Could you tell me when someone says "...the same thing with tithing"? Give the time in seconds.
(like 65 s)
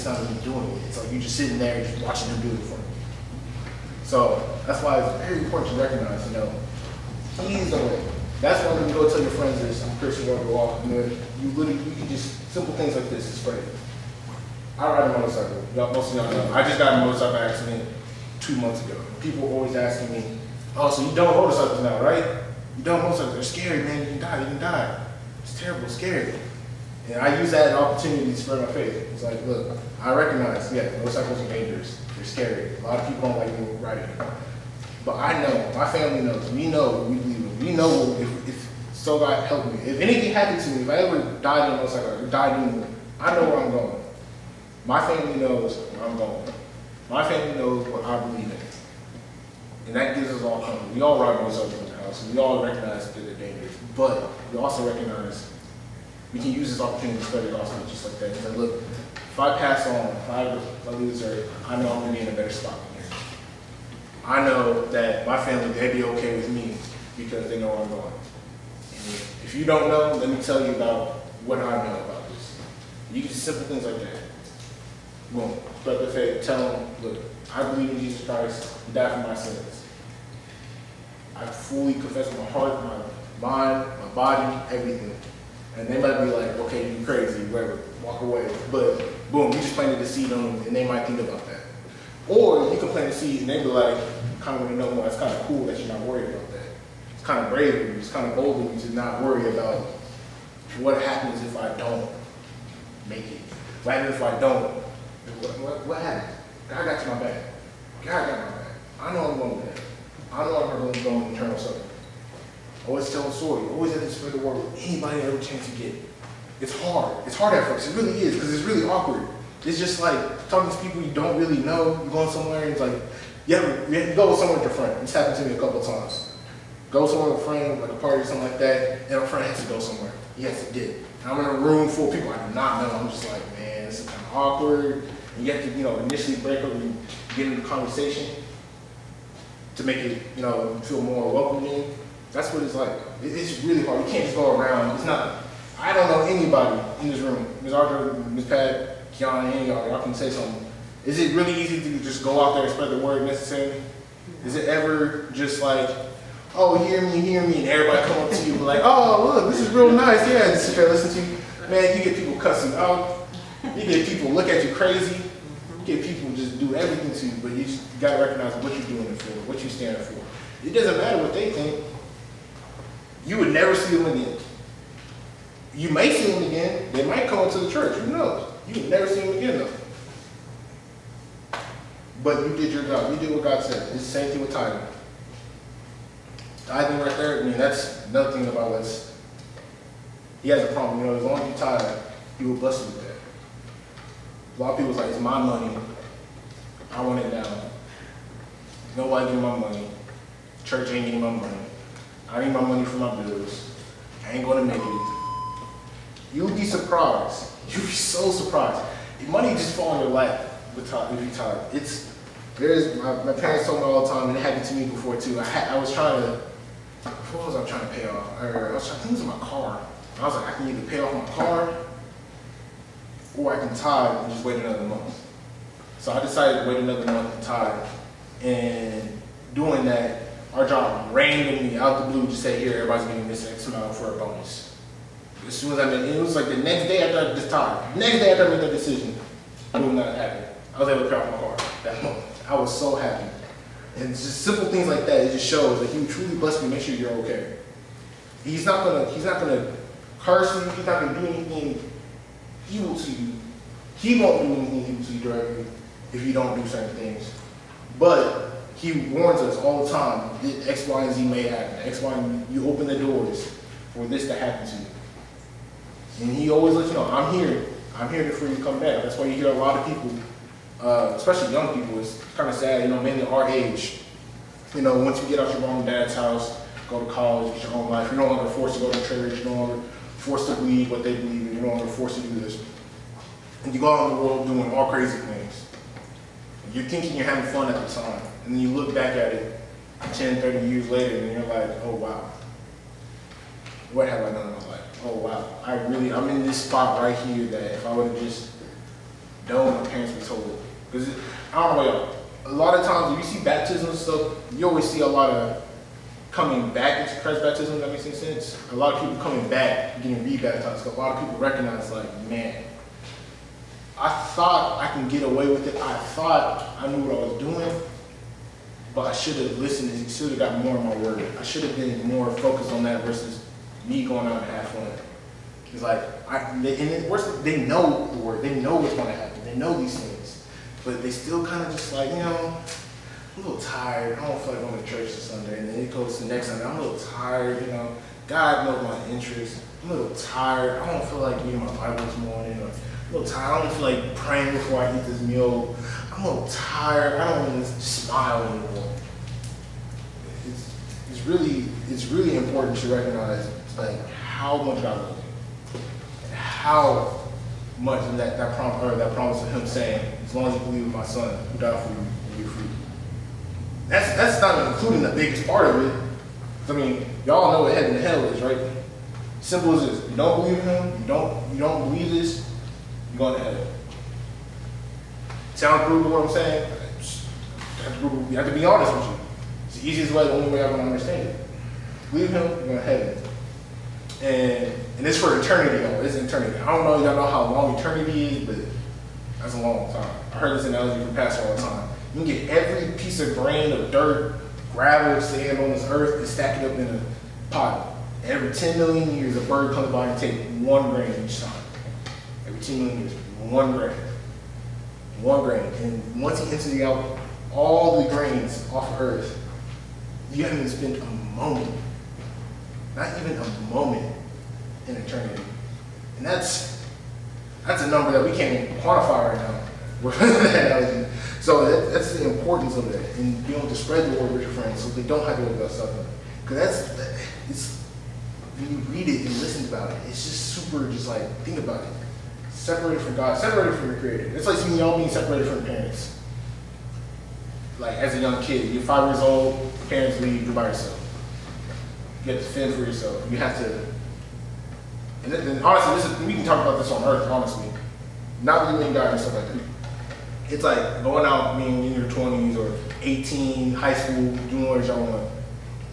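184 s.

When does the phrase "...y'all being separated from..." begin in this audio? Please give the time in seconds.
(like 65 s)
434 s.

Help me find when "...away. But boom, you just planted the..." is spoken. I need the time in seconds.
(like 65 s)
88 s.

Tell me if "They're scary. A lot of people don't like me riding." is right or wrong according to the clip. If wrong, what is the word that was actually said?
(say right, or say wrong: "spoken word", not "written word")
right.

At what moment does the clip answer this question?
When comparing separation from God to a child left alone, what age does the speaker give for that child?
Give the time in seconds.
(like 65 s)
438 s.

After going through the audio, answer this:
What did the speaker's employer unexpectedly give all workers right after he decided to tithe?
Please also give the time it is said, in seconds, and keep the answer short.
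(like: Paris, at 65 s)
A bonus, at 234 s.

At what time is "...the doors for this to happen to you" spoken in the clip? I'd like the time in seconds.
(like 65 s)
262 s.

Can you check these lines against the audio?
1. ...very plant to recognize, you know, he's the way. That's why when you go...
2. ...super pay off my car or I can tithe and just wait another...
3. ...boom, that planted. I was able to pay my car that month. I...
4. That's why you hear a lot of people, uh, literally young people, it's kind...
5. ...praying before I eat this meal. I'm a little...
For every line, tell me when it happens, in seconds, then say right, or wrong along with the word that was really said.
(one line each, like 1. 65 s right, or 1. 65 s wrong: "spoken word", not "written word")
1. 5 s wrong: "important", not "plant"
2. 220 s wrong: "either", not "super"
3. 239 s wrong: "happened", not "planted"
4. 269 s wrong: "especially", not "literally"
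5. 344 s right.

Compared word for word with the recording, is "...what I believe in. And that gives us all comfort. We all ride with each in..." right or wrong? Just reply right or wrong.
right.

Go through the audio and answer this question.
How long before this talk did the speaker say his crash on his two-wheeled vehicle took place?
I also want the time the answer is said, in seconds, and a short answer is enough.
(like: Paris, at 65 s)
2 months ago, at 18 s.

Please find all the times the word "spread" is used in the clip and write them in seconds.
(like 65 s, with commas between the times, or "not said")
28 s, 57 s, 114 s, 152 s, 423 s.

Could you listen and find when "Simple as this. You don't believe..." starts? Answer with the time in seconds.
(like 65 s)
369 s.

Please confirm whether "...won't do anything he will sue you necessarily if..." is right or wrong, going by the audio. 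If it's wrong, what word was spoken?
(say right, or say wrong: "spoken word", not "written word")
wrong: "directly", not "necessarily".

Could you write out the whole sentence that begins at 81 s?
I fully confess my heart, my mind, my body, everything.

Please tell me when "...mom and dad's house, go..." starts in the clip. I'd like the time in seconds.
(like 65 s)
275 s.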